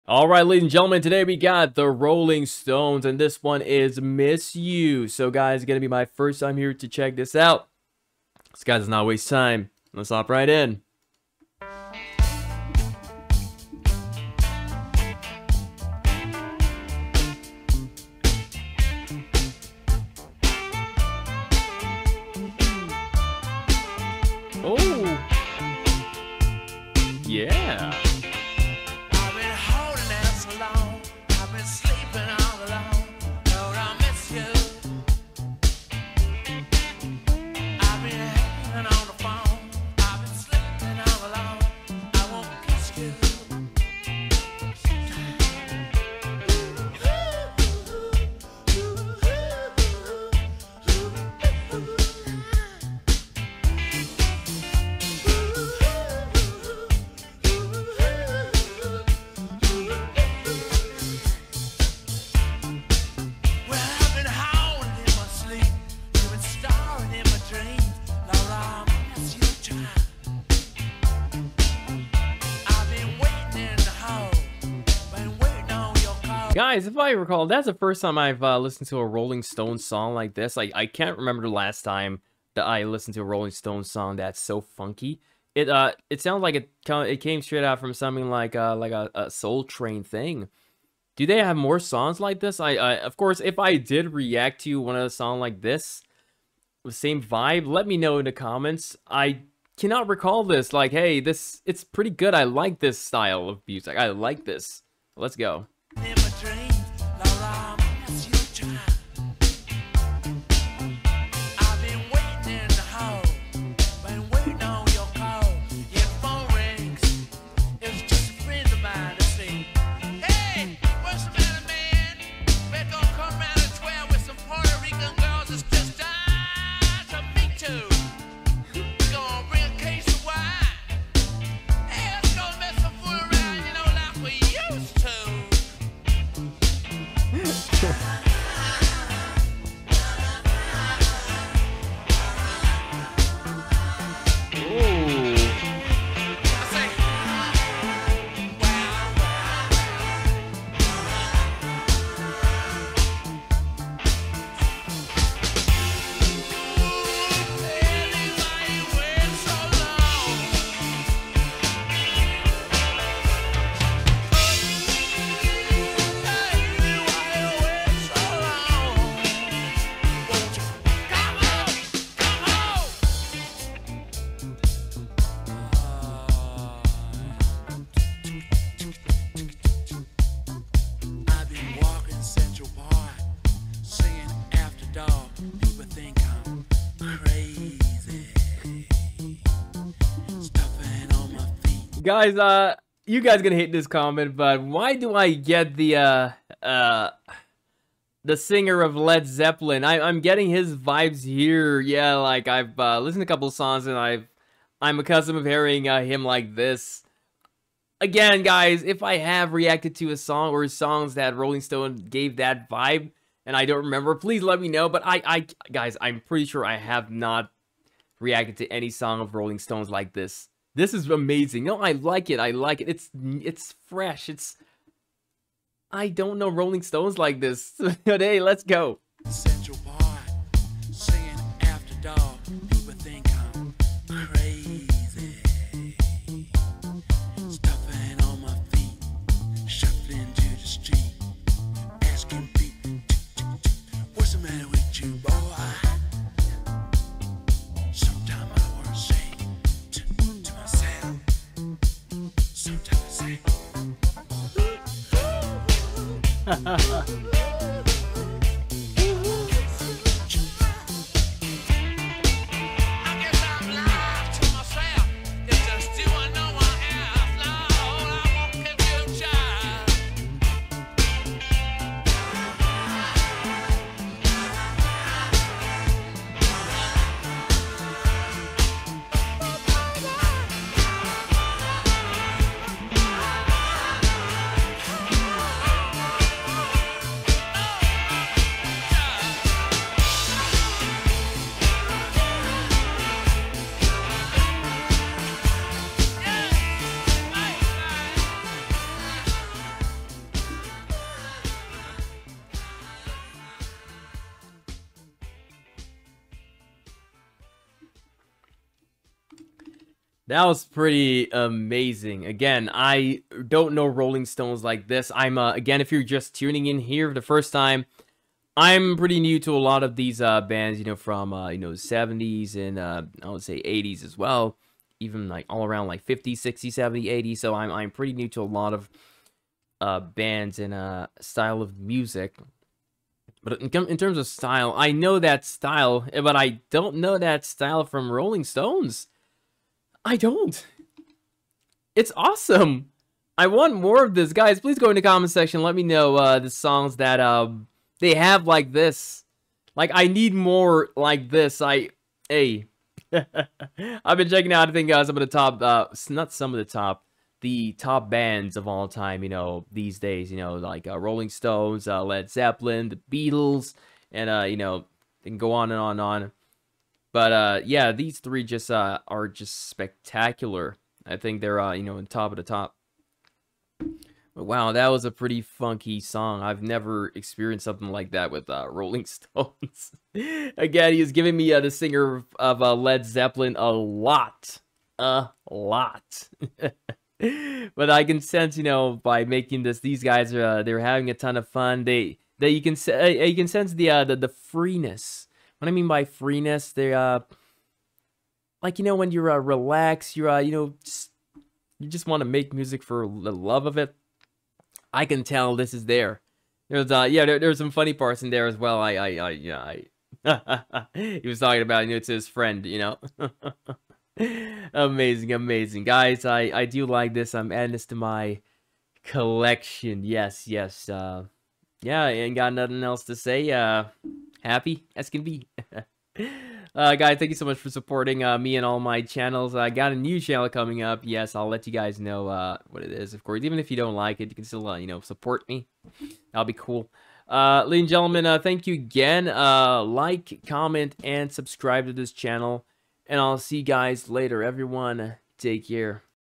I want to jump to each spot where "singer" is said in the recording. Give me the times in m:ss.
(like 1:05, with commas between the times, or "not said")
3:18, 6:21.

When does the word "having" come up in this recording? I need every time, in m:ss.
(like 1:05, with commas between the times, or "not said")
6:30.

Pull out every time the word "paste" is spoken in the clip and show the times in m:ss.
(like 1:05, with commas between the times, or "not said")
not said.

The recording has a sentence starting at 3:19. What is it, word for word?
I, I'm getting his vibes here.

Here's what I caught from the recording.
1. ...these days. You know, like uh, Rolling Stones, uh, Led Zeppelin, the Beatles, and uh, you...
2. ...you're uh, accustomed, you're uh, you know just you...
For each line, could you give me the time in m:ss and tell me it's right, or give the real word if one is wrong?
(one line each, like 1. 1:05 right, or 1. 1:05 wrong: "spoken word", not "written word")
1. 5:59 right
2. 6:39 wrong: "relaxed", not "accustomed".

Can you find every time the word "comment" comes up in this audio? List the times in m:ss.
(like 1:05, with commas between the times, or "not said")
1:38, 3:13, 5:45, 7:20.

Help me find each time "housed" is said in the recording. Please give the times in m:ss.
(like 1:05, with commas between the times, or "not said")
not said.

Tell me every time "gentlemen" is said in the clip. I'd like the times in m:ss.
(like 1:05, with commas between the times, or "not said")
0:00, 7:17.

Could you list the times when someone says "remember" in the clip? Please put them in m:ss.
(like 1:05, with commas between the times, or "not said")
1:21, 3:33.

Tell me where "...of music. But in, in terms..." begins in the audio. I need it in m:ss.
5:31.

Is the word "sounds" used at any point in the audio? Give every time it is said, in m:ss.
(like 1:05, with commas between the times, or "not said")
1:26.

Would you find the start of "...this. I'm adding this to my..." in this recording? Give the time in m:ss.
6:57.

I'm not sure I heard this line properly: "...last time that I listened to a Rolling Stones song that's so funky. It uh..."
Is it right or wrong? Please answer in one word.
right.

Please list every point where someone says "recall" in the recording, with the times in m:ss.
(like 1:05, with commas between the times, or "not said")
1:17, 1:40.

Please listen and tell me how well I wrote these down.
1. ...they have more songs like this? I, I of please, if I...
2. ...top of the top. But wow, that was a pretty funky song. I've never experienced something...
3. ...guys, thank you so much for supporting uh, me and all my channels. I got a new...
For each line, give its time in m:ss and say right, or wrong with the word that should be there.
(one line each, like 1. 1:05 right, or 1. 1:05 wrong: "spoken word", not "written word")
1. 1:31 wrong: "course", not "please"
2. 6:12 right
3. 7:06 right.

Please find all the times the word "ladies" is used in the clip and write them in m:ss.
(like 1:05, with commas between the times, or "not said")
0:00, 7:17.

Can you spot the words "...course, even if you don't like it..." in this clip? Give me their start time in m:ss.
7:13.